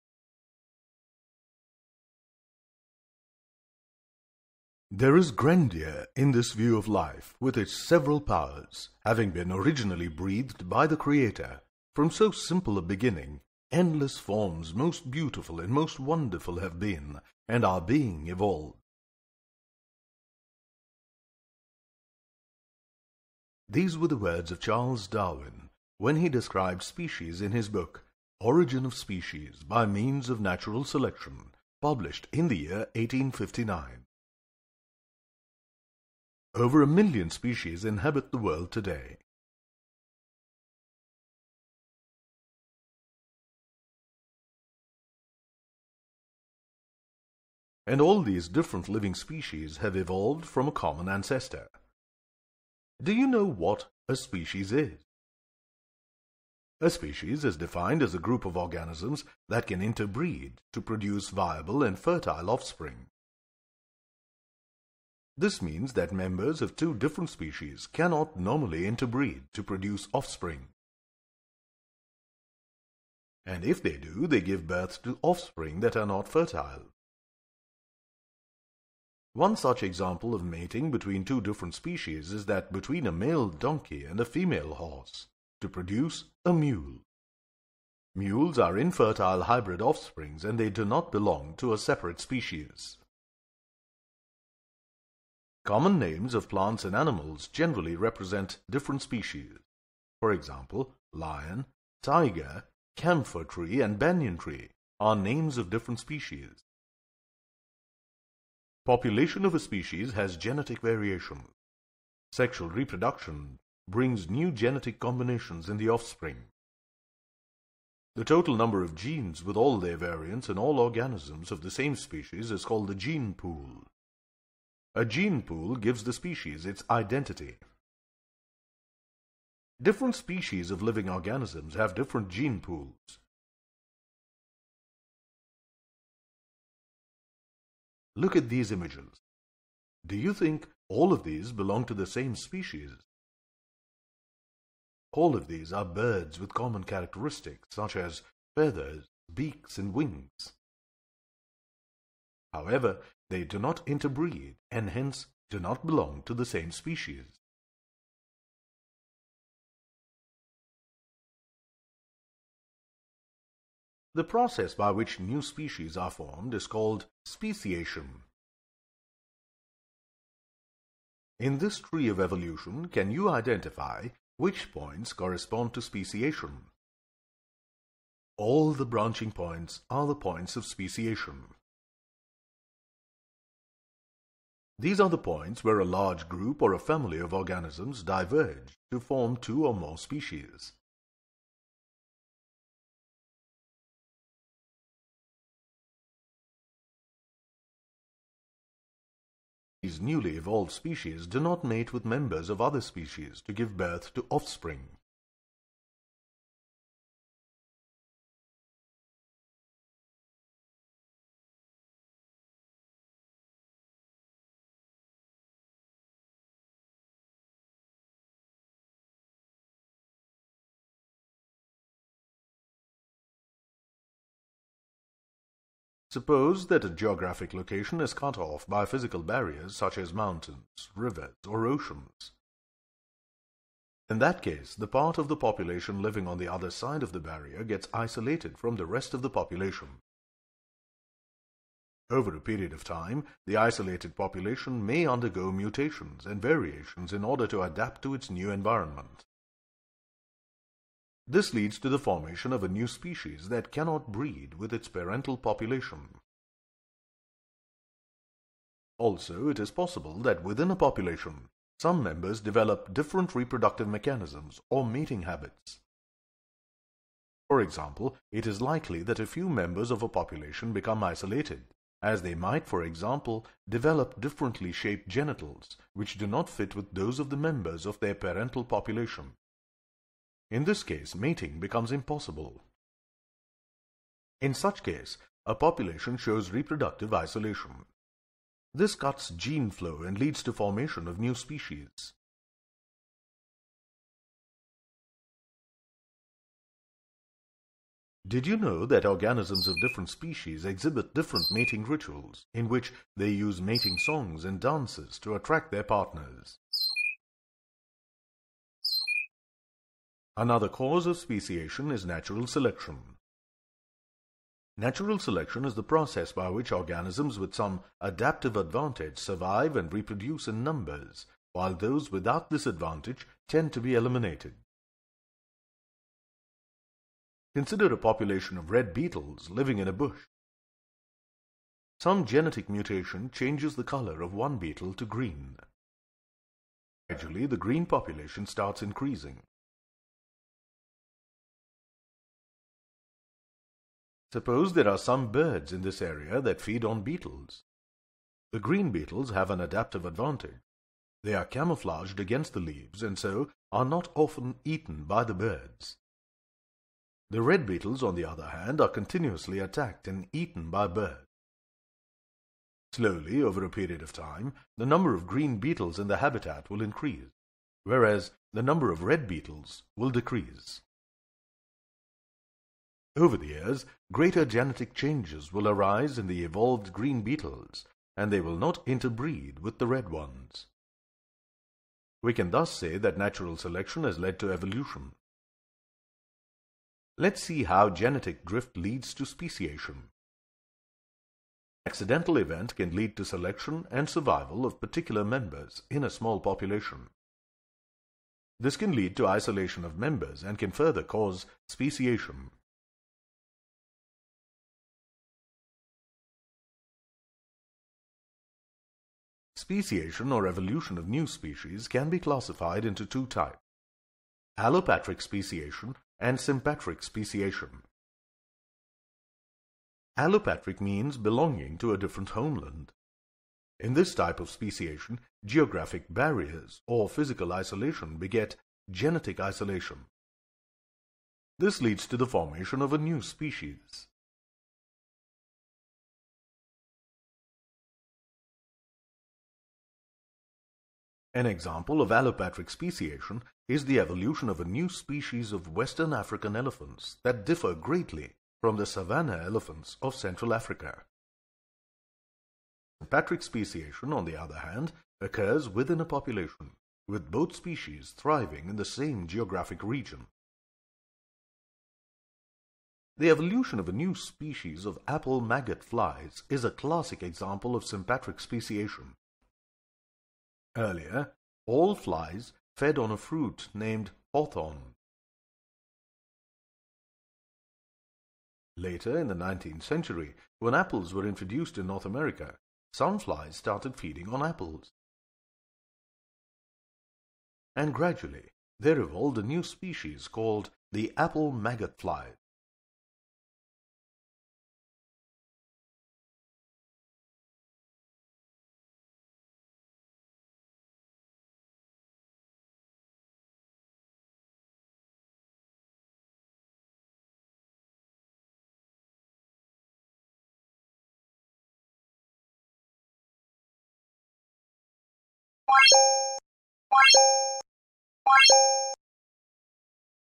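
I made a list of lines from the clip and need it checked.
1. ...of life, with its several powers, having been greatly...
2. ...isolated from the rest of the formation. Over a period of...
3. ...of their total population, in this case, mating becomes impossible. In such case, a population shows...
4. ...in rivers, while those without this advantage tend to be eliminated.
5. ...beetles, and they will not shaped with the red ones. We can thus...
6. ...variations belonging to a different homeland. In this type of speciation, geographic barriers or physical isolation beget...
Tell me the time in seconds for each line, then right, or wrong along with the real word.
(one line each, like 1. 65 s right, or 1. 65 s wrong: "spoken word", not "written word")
1. 6 s wrong: "originally", not "greatly"
2. 237 s wrong: "population", not "formation"
3. 277 s wrong: "parental", not "total"
4. 320 s wrong: "numbers", not "rivers"
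5. 377 s wrong: "interbreed", not "shaped"
6. 420 s wrong: "means", not "variations".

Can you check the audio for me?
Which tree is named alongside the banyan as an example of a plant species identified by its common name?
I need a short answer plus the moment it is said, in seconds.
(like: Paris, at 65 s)
Camphor tree, at 102 s.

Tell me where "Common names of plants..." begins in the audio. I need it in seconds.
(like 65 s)
95 s.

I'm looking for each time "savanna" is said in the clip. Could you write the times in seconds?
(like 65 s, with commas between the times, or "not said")
448 s.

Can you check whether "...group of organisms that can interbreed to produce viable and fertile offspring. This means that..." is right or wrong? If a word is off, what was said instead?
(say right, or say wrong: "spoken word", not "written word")
right.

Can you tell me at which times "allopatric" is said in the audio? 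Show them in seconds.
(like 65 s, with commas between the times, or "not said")
414 s, 420 s, 442 s.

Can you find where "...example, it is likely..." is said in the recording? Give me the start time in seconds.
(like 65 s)
267 s.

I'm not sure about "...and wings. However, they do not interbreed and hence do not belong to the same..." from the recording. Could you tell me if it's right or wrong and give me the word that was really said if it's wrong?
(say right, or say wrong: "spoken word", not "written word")
right.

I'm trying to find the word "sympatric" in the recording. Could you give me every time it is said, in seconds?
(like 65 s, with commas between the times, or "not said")
416 s, 453 s, 467 s.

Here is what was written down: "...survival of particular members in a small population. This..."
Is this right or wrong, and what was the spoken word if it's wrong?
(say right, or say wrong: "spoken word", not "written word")
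right.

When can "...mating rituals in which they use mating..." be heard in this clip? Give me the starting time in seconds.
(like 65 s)
301 s.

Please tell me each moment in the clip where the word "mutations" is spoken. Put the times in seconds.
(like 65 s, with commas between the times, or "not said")
245 s, 332 s.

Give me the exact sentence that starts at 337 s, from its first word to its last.
Gradually, the green population starts increasing.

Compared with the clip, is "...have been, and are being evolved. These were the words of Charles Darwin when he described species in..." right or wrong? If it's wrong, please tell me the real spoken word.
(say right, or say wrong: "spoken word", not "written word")
right.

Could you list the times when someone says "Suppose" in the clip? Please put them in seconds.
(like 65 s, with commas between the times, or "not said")
226 s, 344 s.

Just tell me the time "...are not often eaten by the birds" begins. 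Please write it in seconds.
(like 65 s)
353 s.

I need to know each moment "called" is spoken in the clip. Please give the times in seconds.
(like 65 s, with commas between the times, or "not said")
122 s, 166 s, 490 s.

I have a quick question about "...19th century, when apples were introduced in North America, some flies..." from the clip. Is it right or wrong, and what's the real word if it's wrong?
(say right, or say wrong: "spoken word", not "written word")
right.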